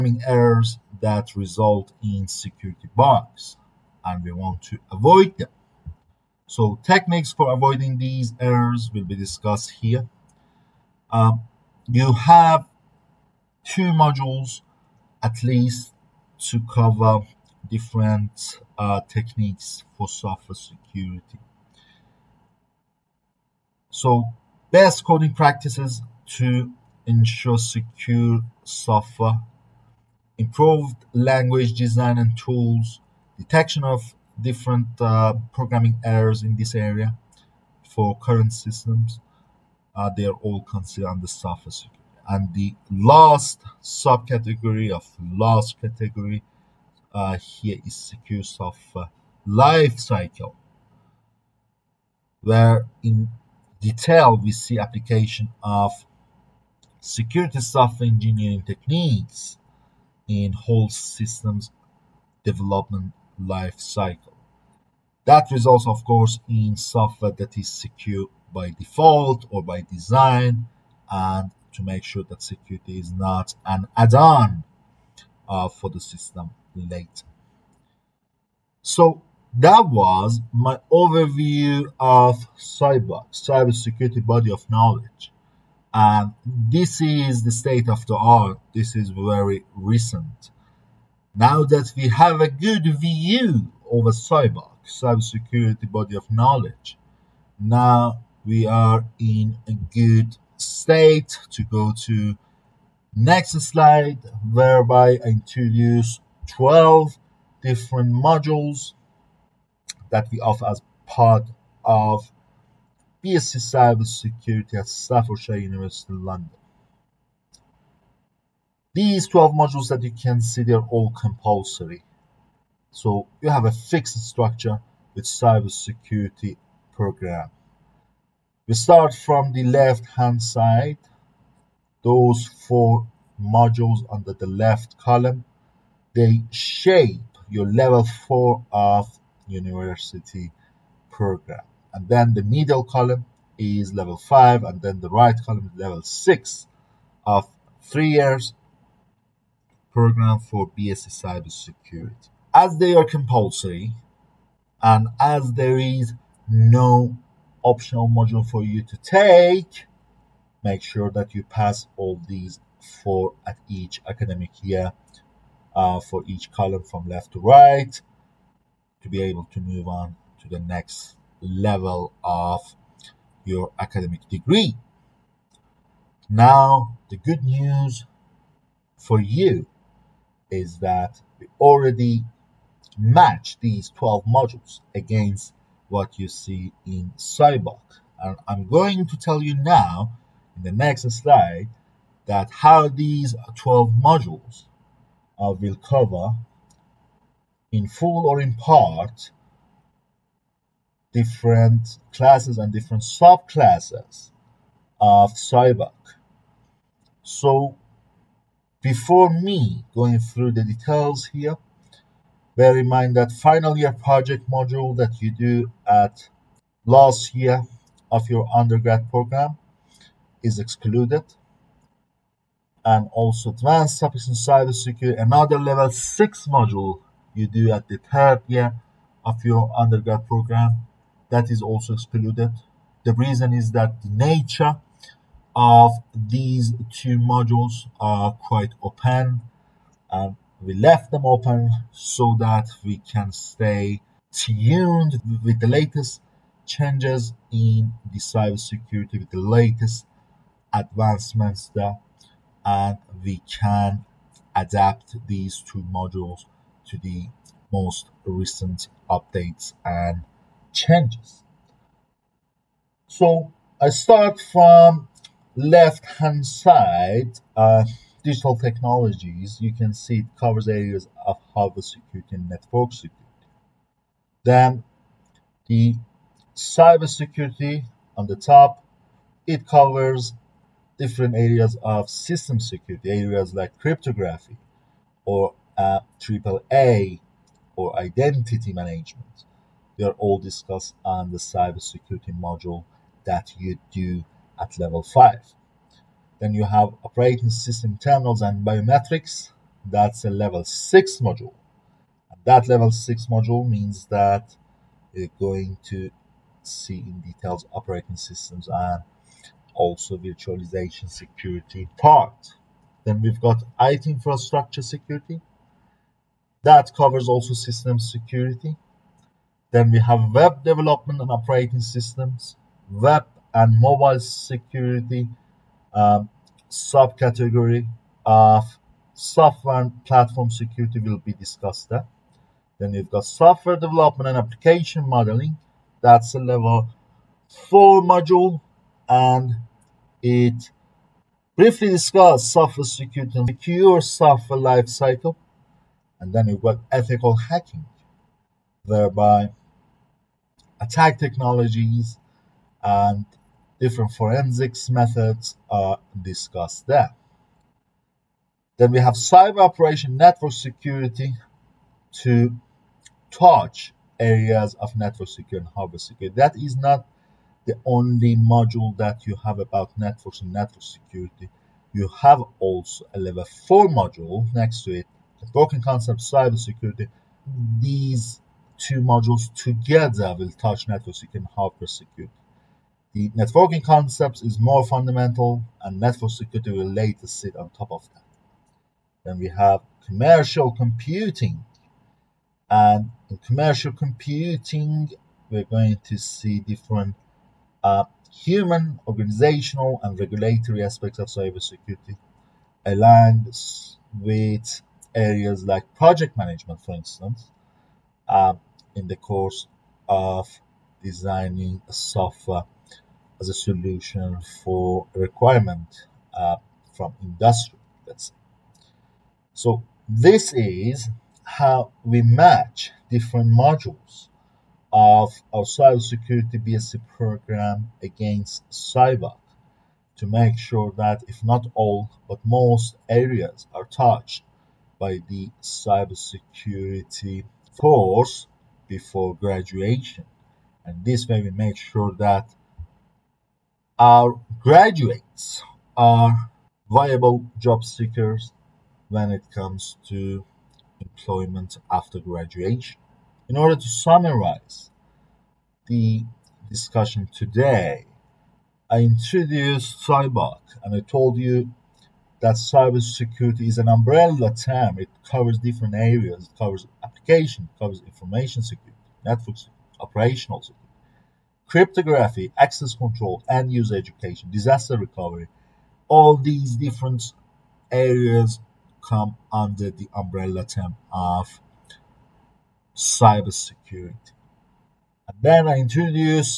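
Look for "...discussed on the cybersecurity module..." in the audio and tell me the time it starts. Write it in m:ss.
4:50.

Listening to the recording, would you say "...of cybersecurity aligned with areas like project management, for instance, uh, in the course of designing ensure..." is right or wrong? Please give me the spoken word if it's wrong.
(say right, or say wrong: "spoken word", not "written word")
wrong: "software", not "ensure".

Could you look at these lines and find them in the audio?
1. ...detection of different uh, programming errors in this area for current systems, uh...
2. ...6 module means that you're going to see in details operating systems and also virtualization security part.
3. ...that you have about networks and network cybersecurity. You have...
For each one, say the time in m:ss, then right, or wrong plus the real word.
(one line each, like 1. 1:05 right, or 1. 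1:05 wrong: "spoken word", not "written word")
1. 0:33 right
2. 5:02 right
3. 6:08 wrong: "security", not "cybersecurity".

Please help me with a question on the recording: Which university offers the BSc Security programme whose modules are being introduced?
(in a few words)
Staffordshire University London.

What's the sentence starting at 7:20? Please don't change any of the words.
And this way we make sure that our graduates are viable job seekers when it comes to employment after graduation.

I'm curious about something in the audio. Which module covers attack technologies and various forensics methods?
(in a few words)
Ethical hacking.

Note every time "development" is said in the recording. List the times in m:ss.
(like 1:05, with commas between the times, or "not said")
1:02, 5:20, 5:33.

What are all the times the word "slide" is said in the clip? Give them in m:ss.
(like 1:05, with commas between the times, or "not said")
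1:43, 3:11.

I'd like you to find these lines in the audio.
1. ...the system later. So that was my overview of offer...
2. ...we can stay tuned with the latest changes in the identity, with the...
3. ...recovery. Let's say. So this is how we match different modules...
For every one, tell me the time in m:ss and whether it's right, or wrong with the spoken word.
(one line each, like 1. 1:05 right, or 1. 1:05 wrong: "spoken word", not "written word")
1. 1:15 wrong: "cyber", not "offer"
2. 4:02 wrong: "cybersecurity", not "identity"
3. 6:57 wrong: "industry", not "recovery".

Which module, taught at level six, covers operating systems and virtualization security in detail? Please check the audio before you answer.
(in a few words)
Operating system terminals and biometrics.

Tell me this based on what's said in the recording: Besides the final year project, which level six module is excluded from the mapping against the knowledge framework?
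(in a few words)
Advanced topics in cybersecurity.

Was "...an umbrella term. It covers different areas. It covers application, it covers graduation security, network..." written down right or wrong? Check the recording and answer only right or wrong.
wrong.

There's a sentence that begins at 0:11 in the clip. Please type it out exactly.
Um, you have two modules at least to cover different uh, techniques for software security.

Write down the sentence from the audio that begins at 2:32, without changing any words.
As they are compulsory, and as there is no optional module for you to take.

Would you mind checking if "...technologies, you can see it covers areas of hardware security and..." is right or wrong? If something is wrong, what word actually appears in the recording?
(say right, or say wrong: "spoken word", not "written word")
right.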